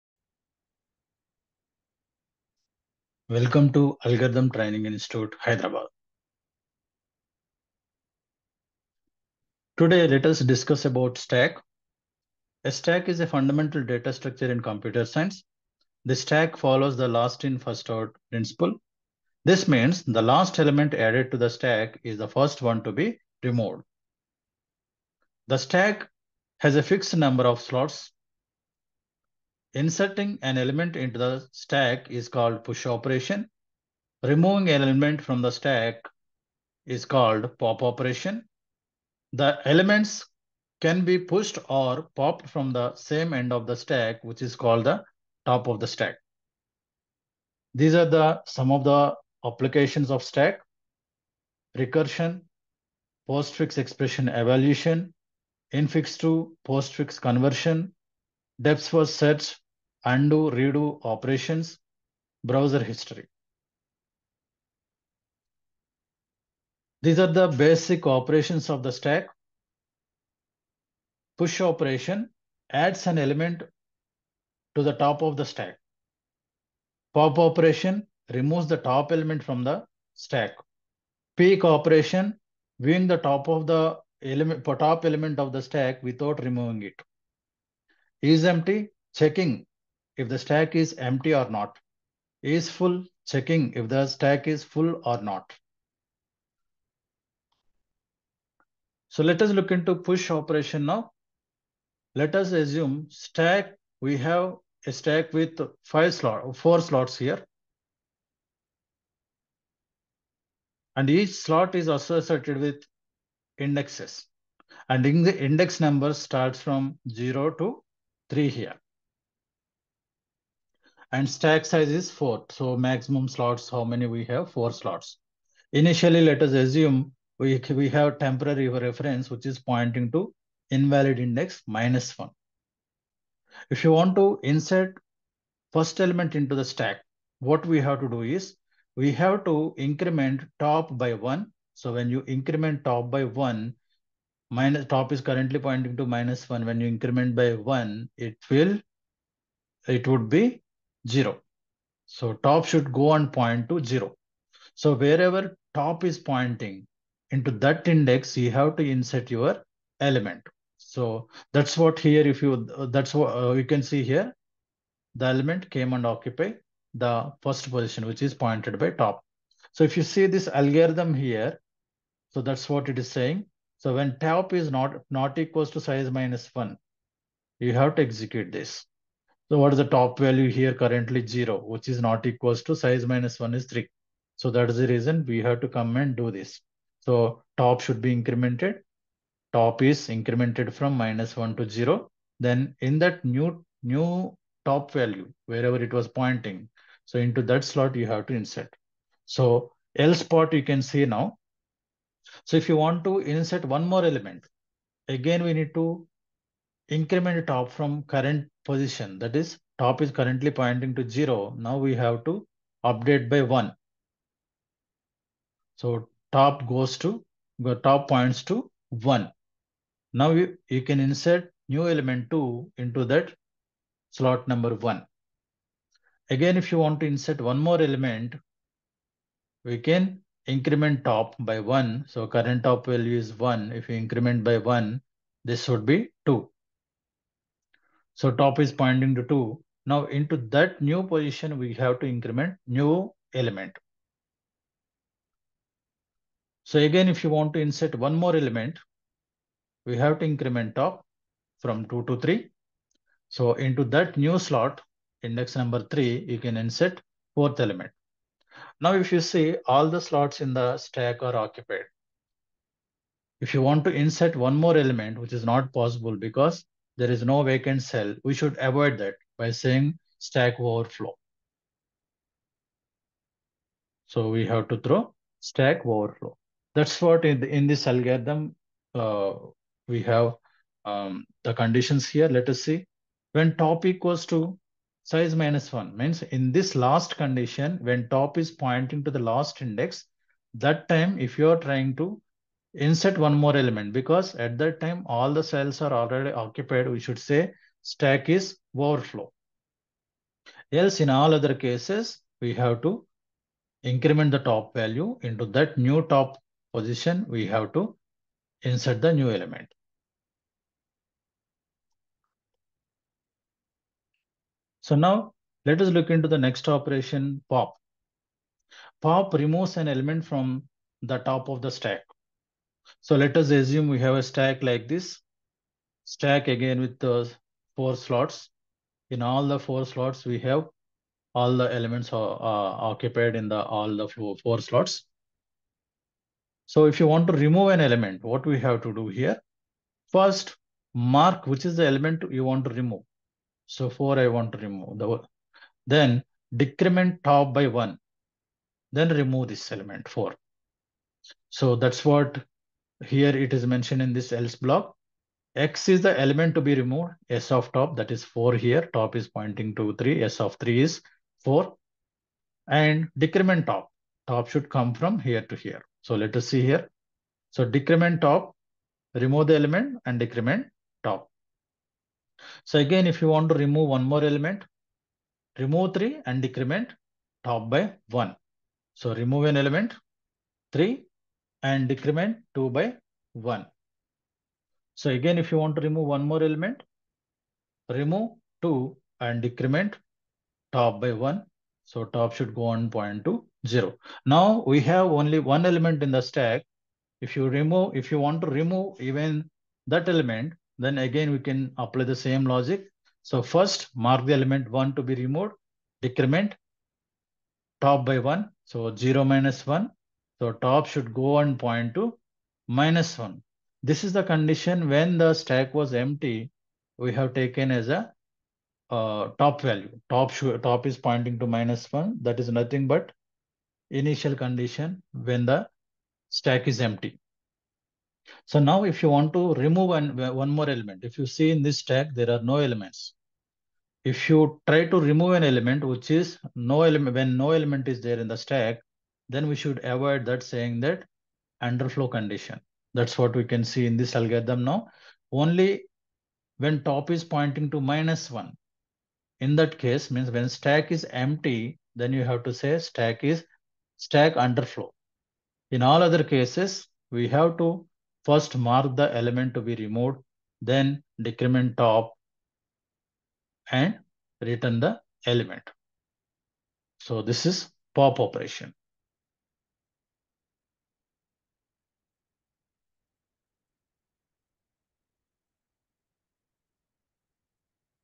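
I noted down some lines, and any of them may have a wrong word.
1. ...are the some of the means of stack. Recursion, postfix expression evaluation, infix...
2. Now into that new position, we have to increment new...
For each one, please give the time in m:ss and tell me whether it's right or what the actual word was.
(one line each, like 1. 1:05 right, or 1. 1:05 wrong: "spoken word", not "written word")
1. 0:47 wrong: "applications", not "means"
2. 3:59 right.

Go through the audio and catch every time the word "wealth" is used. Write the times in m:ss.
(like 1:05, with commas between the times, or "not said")
not said.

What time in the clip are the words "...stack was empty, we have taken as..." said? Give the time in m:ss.
6:55.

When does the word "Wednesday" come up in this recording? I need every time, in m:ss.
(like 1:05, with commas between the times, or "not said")
not said.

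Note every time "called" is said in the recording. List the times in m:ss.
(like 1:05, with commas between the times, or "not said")
0:32, 0:37, 0:44.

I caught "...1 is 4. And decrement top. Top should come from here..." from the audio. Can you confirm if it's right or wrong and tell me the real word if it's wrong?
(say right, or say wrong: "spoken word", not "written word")
wrong: "3", not "1".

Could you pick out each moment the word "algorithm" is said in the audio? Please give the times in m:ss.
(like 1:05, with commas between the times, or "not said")
0:04, 2:50, 4:37, 7:24.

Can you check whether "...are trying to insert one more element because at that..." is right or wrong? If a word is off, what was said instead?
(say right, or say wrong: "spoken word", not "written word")
right.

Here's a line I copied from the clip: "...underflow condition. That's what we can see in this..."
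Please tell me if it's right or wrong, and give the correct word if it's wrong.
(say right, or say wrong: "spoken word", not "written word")
right.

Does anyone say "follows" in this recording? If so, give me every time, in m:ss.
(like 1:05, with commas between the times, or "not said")
0:16.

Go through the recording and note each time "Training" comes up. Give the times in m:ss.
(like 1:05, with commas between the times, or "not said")
0:04.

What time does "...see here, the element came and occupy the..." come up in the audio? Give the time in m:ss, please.
2:43.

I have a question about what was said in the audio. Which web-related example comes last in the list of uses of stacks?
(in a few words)
Browser history.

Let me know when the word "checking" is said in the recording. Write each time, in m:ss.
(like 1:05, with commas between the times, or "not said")
1:29, 1:33.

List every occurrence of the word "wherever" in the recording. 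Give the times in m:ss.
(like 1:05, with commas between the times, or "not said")
2:34, 3:15.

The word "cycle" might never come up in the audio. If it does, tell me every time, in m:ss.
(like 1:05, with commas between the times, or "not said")
not said.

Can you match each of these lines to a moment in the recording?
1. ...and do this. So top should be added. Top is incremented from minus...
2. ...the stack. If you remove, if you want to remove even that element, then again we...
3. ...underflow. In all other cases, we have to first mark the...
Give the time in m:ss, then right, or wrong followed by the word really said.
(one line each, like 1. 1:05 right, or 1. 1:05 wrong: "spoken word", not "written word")
1. 3:05 wrong: "incremented", not "added"
2. 6:36 right
3. 7:34 right.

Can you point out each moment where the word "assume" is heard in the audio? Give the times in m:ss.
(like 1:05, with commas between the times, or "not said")
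1:42, 2:06, 5:23.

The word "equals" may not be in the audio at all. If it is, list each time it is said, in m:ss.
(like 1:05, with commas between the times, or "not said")
2:55, 3:02, 4:43.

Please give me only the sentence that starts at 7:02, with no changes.
That is nothing but initial condition when the stack is empty.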